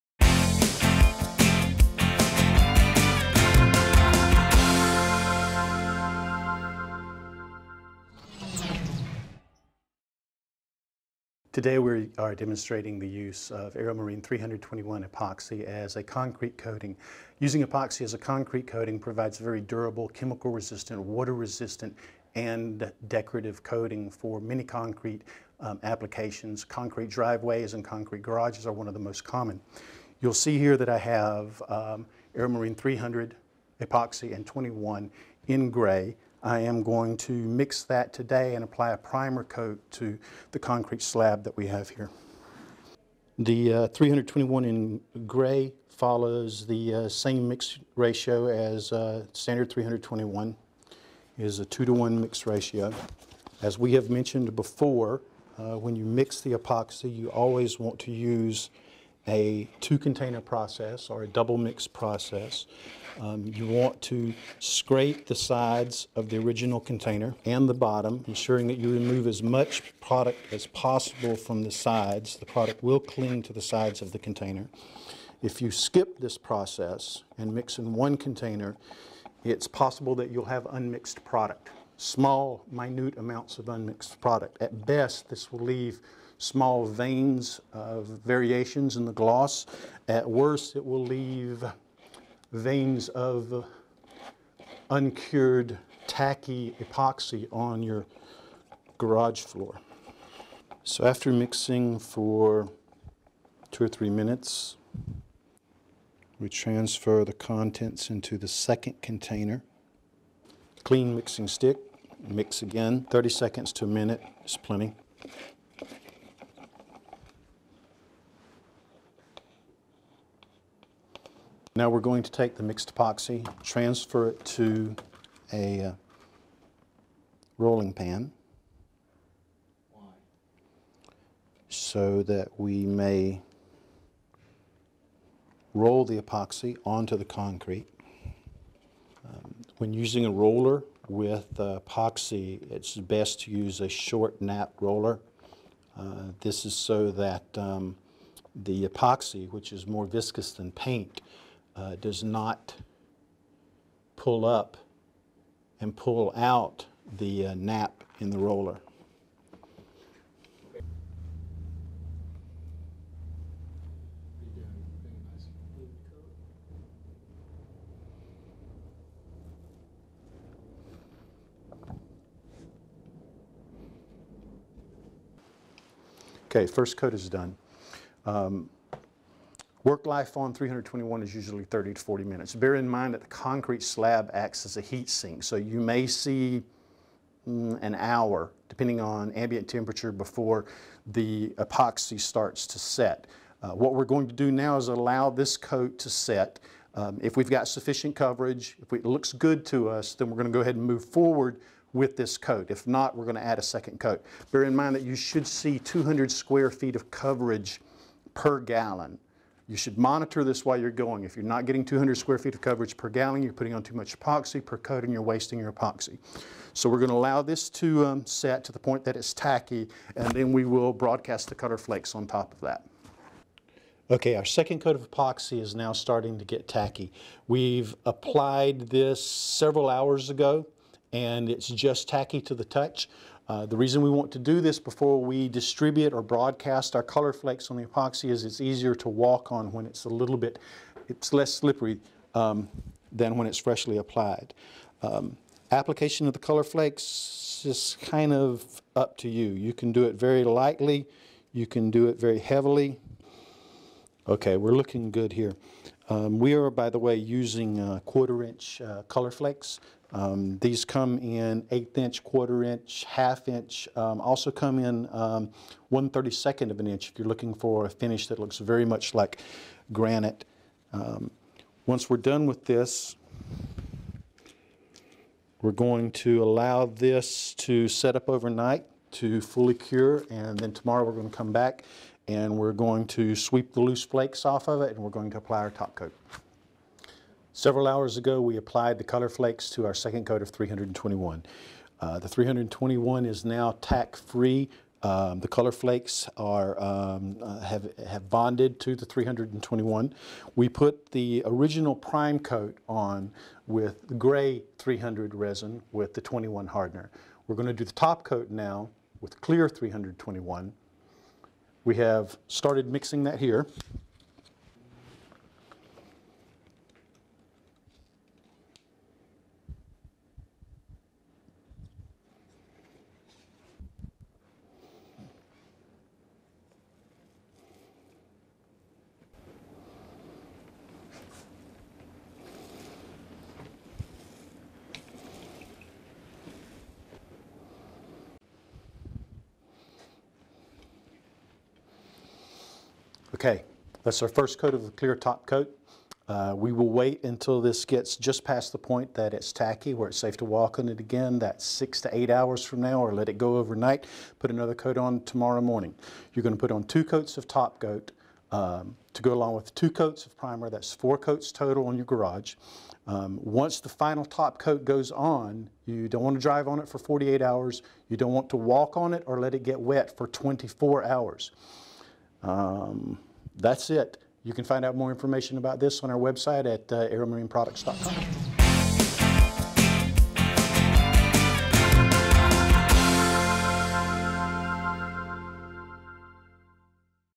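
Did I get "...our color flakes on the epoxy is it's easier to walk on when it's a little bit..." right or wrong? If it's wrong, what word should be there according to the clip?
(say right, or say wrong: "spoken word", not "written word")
right.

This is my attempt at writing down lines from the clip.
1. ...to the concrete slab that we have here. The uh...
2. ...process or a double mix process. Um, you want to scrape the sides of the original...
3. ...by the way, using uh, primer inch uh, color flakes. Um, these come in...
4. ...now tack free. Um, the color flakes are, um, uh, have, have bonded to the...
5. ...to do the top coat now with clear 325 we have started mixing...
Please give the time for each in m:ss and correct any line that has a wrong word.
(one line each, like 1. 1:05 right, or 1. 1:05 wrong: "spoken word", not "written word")
1. 0:39 right
2. 1:00 right
3. 4:16 wrong: "quarter", not "primer"
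4. 4:53 right
5. 5:07 wrong: "321", not "325".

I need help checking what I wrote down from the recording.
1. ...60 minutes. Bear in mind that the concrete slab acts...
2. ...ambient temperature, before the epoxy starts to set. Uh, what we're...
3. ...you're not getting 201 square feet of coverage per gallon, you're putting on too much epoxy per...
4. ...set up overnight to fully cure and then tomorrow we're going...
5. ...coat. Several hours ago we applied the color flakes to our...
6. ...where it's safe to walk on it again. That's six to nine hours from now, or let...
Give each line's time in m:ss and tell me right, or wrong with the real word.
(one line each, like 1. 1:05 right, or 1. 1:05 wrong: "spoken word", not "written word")
1. 3:02 wrong: "40", not "60"
2. 3:09 right
3. 3:31 wrong: "200", not "201"
4. 4:37 right
5. 4:45 right
6. 5:49 wrong: "eight", not "nine".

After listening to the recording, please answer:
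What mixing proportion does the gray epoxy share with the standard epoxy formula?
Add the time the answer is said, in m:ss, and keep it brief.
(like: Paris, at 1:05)
2 to 1, at 0:51.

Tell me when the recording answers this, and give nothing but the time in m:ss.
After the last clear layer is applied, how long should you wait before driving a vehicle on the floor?
6:06.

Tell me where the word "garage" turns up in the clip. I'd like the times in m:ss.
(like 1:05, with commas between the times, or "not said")
0:28, 1:38, 6:02.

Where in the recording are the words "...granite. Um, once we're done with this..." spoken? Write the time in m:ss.
4:29.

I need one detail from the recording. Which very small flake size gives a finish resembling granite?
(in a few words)
1/32 inch.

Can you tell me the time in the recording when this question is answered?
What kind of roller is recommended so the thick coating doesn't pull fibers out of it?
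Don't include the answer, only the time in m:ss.
2:23.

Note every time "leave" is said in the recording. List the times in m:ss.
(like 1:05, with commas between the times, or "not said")
1:25, 1:31.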